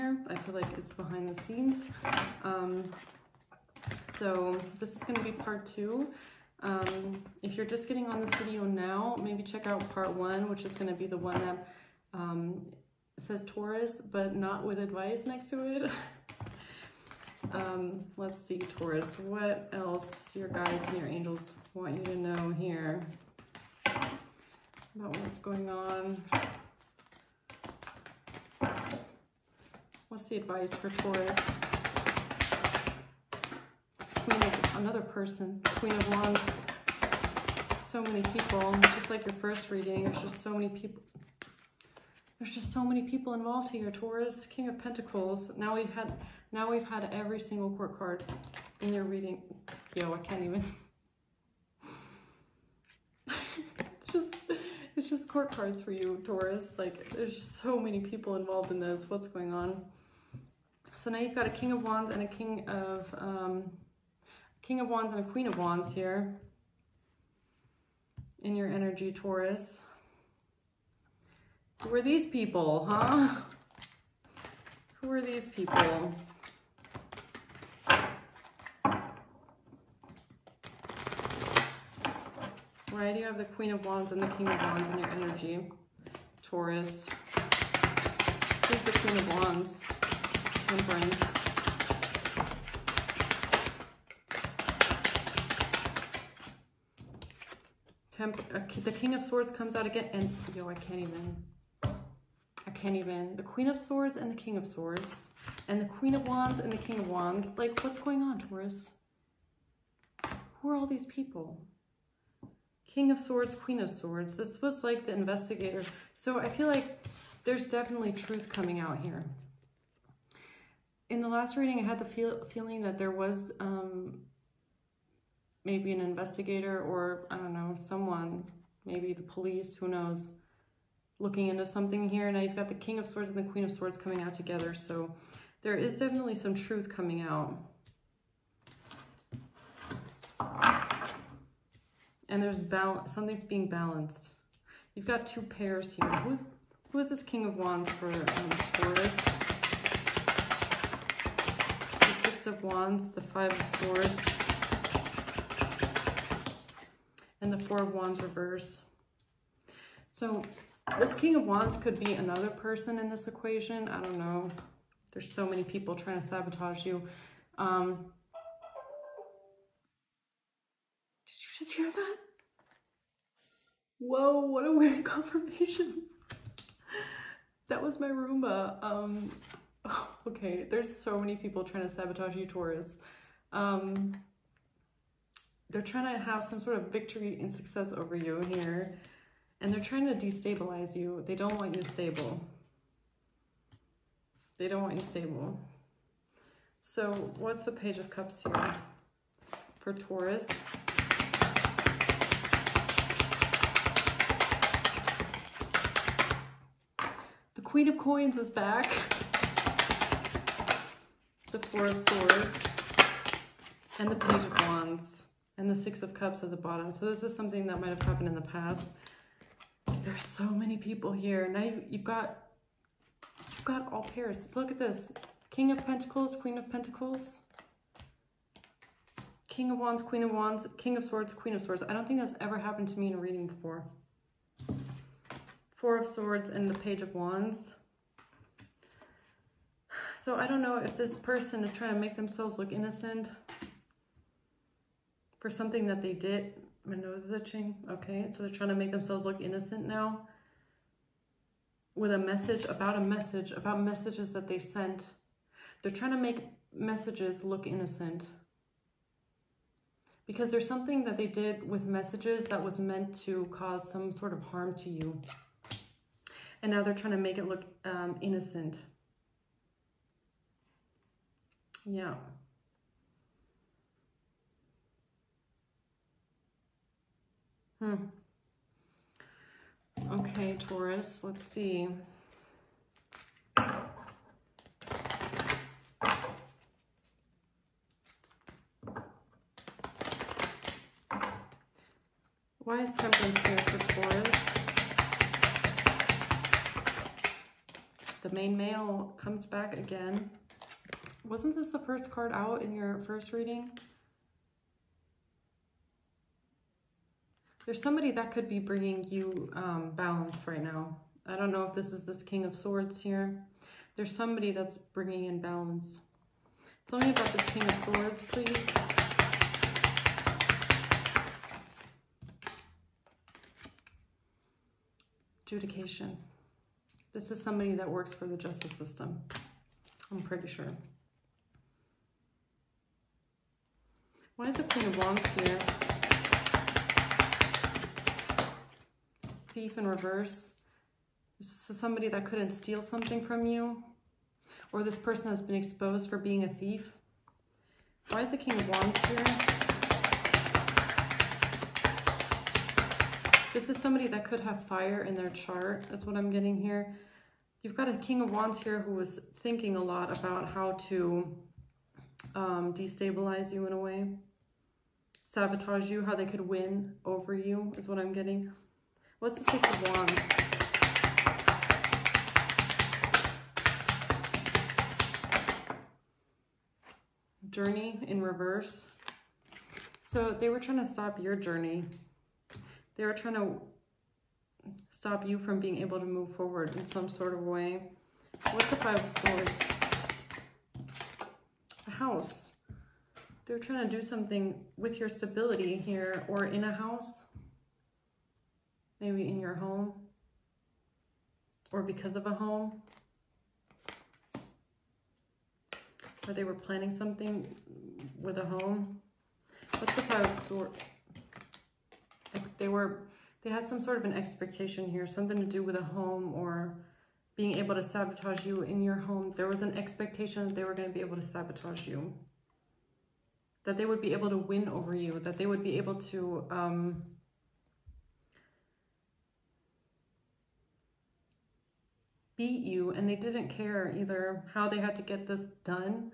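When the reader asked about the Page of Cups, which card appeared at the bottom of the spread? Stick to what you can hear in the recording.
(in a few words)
Six of Cups.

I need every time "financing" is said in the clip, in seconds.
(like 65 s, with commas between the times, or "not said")
not said.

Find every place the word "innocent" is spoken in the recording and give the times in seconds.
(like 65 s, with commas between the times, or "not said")
242 s, 249 s, 257 s, 268 s.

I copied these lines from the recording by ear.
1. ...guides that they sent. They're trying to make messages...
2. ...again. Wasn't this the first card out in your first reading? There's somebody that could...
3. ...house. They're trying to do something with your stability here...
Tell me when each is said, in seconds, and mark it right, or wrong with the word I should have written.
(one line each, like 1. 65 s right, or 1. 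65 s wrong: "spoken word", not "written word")
1. 253 s wrong: "messages", not "guides"
2. 299 s right
3. 391 s right.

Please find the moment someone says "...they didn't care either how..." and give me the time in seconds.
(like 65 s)
433 s.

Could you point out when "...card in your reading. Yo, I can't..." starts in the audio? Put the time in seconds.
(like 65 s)
47 s.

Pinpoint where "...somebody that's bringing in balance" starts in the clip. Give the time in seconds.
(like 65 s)
314 s.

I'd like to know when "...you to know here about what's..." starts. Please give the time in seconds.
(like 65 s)
21 s.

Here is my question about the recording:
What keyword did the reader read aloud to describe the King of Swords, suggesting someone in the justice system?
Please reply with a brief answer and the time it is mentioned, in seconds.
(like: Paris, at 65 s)
Adjudication, at 325 s.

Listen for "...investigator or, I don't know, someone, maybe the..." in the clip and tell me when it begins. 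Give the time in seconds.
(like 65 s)
125 s.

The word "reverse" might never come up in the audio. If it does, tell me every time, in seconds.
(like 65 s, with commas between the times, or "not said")
158 s, 339 s, 378 s.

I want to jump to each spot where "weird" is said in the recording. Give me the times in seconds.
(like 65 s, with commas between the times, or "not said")
174 s.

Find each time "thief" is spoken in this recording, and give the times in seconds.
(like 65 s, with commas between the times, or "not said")
339 s, 346 s.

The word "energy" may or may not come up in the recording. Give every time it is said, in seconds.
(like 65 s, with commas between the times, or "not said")
68 s, 85 s.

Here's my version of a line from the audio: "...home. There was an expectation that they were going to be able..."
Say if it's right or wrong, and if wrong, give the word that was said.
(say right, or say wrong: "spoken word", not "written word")
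right.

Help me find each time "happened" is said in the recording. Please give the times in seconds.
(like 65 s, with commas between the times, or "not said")
218 s, 232 s.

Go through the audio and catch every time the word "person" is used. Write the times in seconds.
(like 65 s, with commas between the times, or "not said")
35 s, 162 s, 241 s, 344 s.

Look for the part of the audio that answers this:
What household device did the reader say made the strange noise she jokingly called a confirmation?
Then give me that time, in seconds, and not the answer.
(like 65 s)
177 s.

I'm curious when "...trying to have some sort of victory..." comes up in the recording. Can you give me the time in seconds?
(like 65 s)
185 s.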